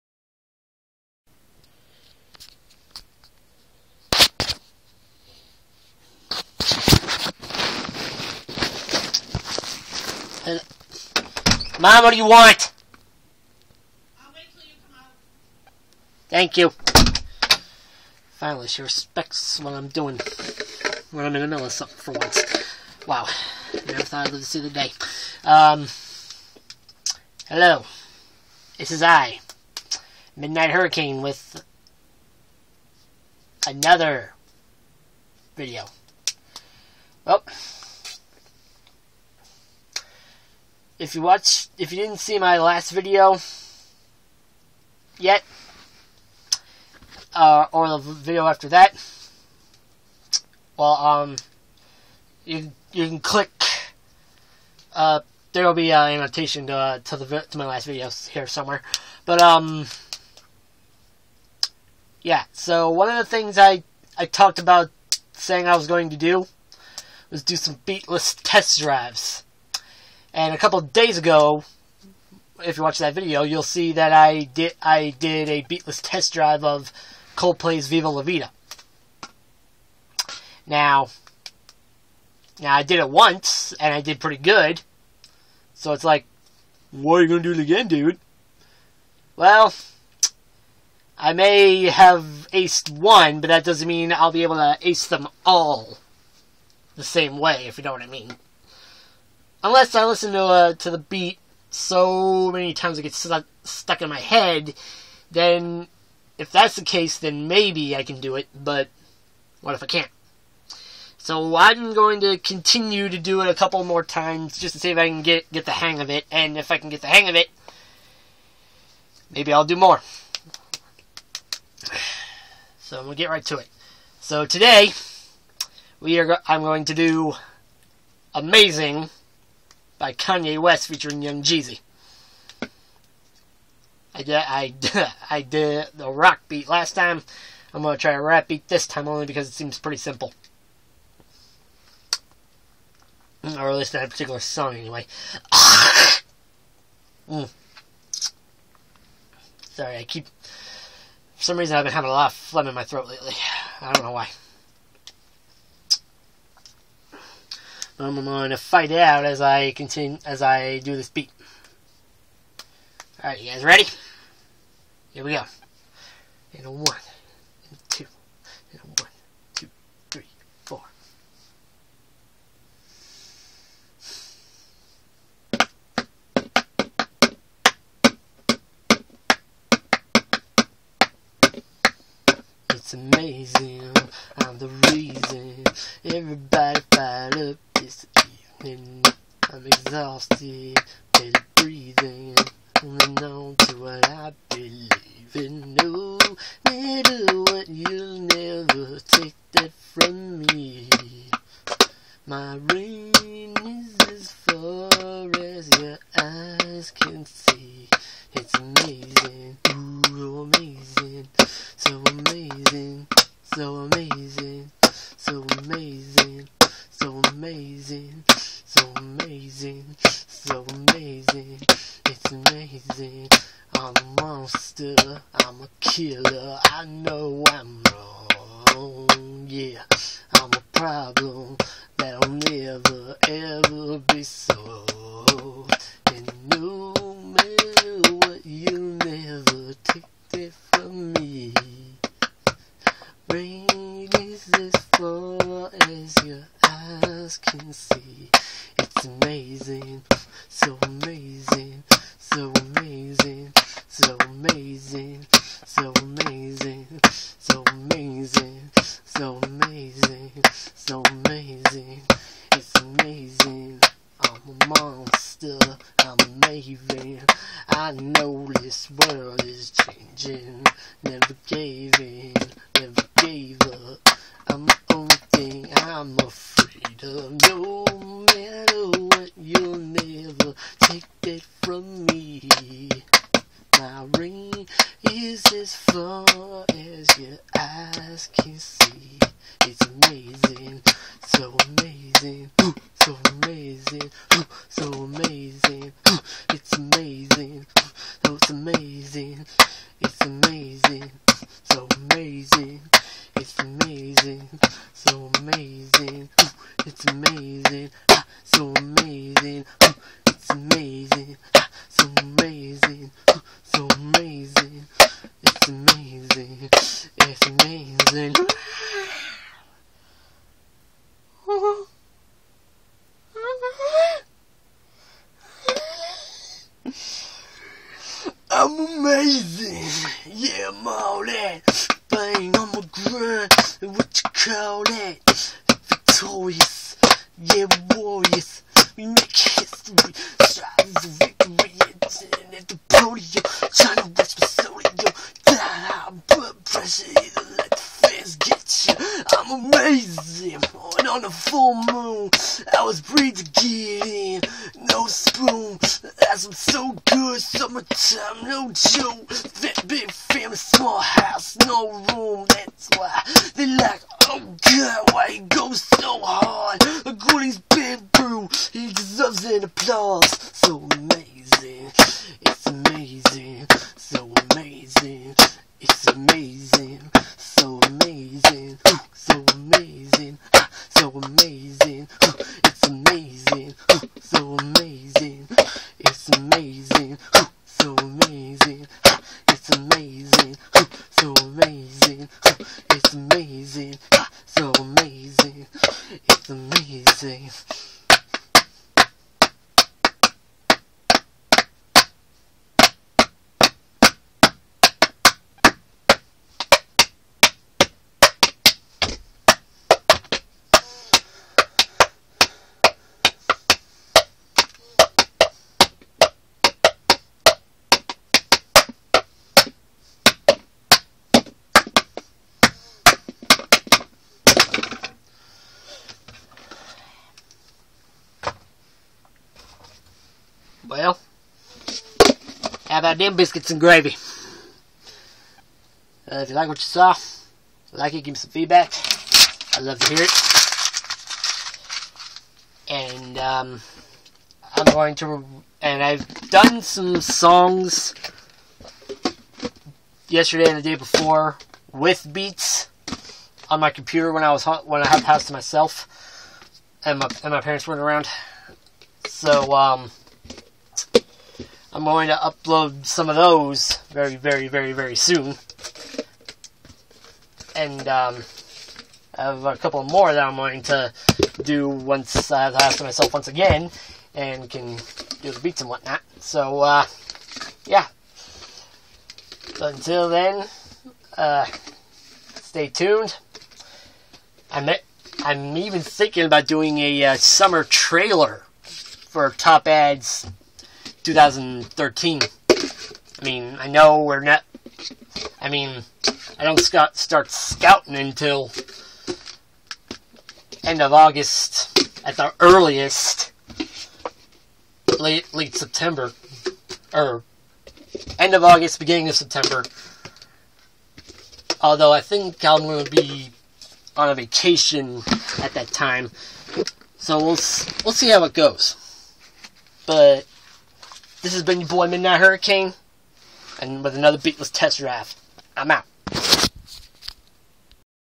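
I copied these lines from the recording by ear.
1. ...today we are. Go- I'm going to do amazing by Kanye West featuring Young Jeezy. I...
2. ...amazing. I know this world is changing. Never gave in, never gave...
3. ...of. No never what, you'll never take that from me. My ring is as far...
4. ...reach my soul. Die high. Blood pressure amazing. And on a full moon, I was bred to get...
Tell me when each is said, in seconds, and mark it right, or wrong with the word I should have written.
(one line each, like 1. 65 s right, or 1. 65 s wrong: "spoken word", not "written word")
1. 124 s right
2. 266 s right
3. 277 s wrong: "matter", not "never"
4. 344 s right.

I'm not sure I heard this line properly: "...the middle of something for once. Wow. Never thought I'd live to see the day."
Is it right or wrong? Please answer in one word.
right.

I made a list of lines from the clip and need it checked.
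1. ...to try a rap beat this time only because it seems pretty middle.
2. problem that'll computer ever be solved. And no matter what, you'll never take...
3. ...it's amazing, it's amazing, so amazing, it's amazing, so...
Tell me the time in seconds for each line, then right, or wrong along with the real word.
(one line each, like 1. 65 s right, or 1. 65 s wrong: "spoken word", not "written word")
1. 137 s wrong: "simple", not "middle"
2. 231 s wrong: "never", not "computer"
3. 298 s right.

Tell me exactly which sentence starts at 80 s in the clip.
Now, now I did it once and I did pretty good.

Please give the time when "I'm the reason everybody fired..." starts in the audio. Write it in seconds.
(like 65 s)
184 s.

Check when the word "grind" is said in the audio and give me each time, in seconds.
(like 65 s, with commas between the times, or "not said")
332 s.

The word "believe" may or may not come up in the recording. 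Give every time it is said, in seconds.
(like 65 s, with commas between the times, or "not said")
194 s.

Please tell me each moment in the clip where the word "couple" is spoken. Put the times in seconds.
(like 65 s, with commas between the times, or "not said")
70 s, 113 s, 469 s.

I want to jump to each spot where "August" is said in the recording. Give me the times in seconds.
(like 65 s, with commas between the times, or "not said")
501 s, 508 s.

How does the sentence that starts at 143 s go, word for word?
Or at least that particular song, anyway.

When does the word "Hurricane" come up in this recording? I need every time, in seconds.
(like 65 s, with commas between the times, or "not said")
30 s, 522 s.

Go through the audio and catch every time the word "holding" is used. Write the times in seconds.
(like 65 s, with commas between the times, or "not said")
192 s.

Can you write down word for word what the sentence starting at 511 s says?
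Although I think I'm going to be on a vacation at that time, so we'll we'll see how it goes.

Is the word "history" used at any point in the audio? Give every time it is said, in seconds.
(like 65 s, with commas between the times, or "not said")
339 s.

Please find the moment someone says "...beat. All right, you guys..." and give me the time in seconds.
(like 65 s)
161 s.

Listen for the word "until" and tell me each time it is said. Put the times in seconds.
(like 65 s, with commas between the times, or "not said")
479 s, 498 s.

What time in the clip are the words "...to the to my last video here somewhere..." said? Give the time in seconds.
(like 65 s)
56 s.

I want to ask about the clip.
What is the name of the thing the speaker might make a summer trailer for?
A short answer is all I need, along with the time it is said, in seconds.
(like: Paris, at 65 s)
Top Ads 2013, at 489 s.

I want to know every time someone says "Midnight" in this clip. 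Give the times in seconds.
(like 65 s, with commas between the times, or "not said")
30 s, 522 s.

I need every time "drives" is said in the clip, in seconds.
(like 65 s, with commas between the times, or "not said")
68 s, 76 s.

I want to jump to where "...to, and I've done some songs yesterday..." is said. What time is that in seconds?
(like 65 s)
445 s.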